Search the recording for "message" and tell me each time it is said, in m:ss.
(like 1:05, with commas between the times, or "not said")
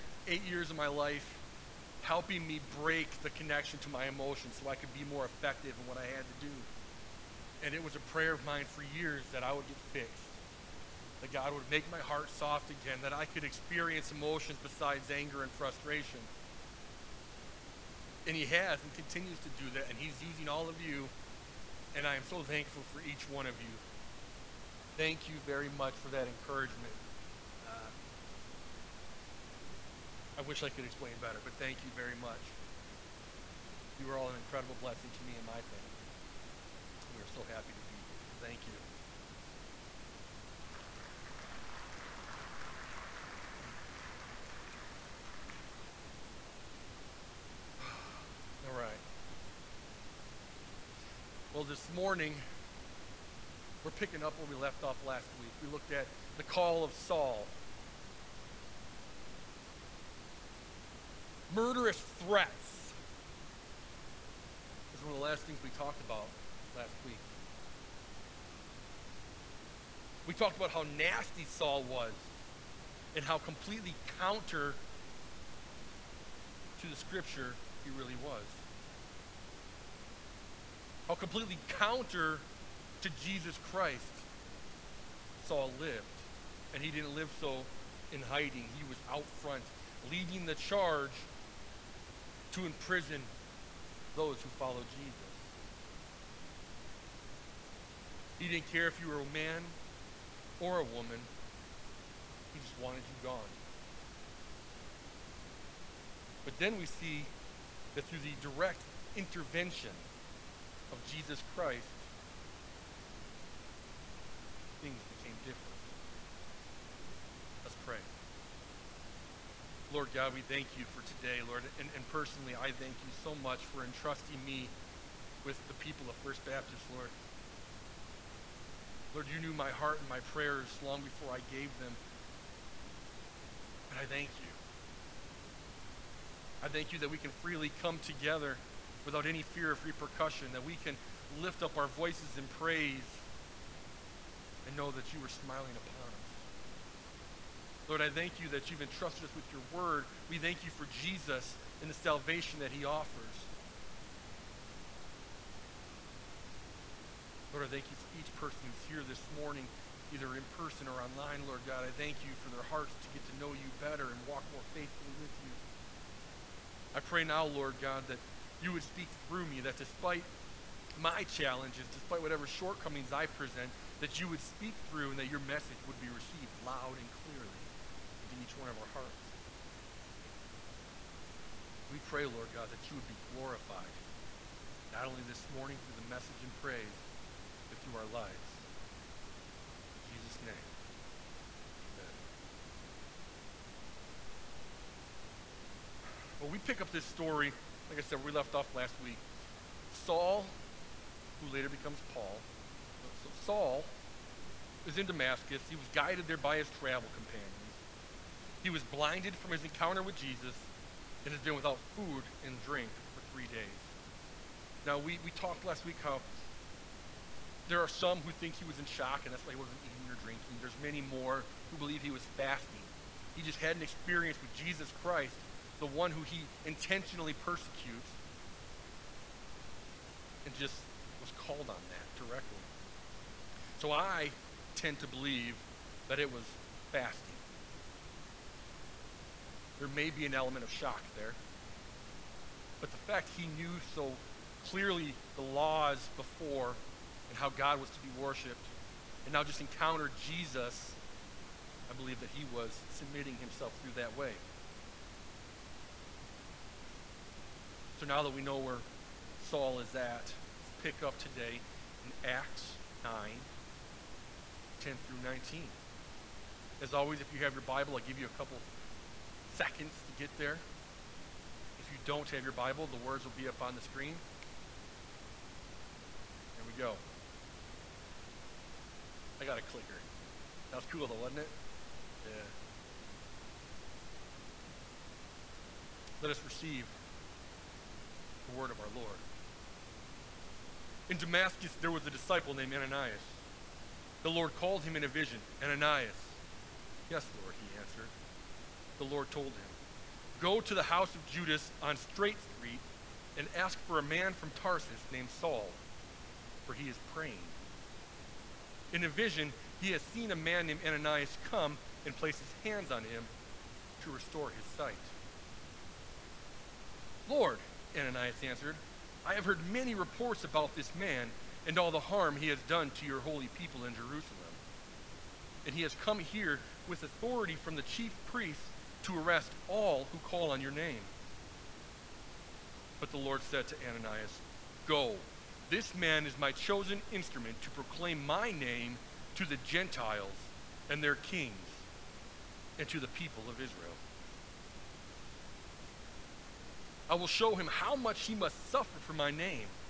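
2:55, 3:06.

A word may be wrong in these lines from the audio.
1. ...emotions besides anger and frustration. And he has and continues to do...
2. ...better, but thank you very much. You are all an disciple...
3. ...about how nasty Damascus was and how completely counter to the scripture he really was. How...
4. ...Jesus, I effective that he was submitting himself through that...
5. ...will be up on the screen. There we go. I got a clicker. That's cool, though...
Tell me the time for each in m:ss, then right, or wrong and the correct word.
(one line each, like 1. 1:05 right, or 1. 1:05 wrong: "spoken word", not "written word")
1. 0:14 right
2. 0:31 wrong: "incredible", not "disciple"
3. 1:10 wrong: "Saul", not "Damascus"
4. 4:10 wrong: "believe", not "effective"
5. 4:33 right.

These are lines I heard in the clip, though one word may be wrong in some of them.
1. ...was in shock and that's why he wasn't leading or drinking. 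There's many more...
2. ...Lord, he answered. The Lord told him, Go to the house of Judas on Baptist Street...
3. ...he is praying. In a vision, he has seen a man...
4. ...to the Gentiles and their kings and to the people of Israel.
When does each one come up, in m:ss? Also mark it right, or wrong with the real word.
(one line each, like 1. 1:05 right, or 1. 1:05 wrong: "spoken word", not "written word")
1. 3:38 wrong: "eating", not "leading"
2. 4:57 wrong: "Straight", not "Baptist"
3. 5:06 right
4. 5:39 right.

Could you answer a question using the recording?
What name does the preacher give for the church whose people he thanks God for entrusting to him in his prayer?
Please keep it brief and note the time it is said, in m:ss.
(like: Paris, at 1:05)
First Baptist, at 2:06.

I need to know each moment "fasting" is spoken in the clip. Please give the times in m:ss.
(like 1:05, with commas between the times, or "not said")
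3:42, 3:56.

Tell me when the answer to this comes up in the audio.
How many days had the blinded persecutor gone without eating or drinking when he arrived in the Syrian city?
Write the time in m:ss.
3:33.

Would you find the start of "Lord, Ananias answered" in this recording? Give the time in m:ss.
5:17.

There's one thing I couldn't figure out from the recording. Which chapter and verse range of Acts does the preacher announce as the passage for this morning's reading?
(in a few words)
Acts 9:10-19.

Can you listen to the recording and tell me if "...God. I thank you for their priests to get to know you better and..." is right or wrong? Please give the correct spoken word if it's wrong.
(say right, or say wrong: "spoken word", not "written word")
wrong: "hearts", not "priests".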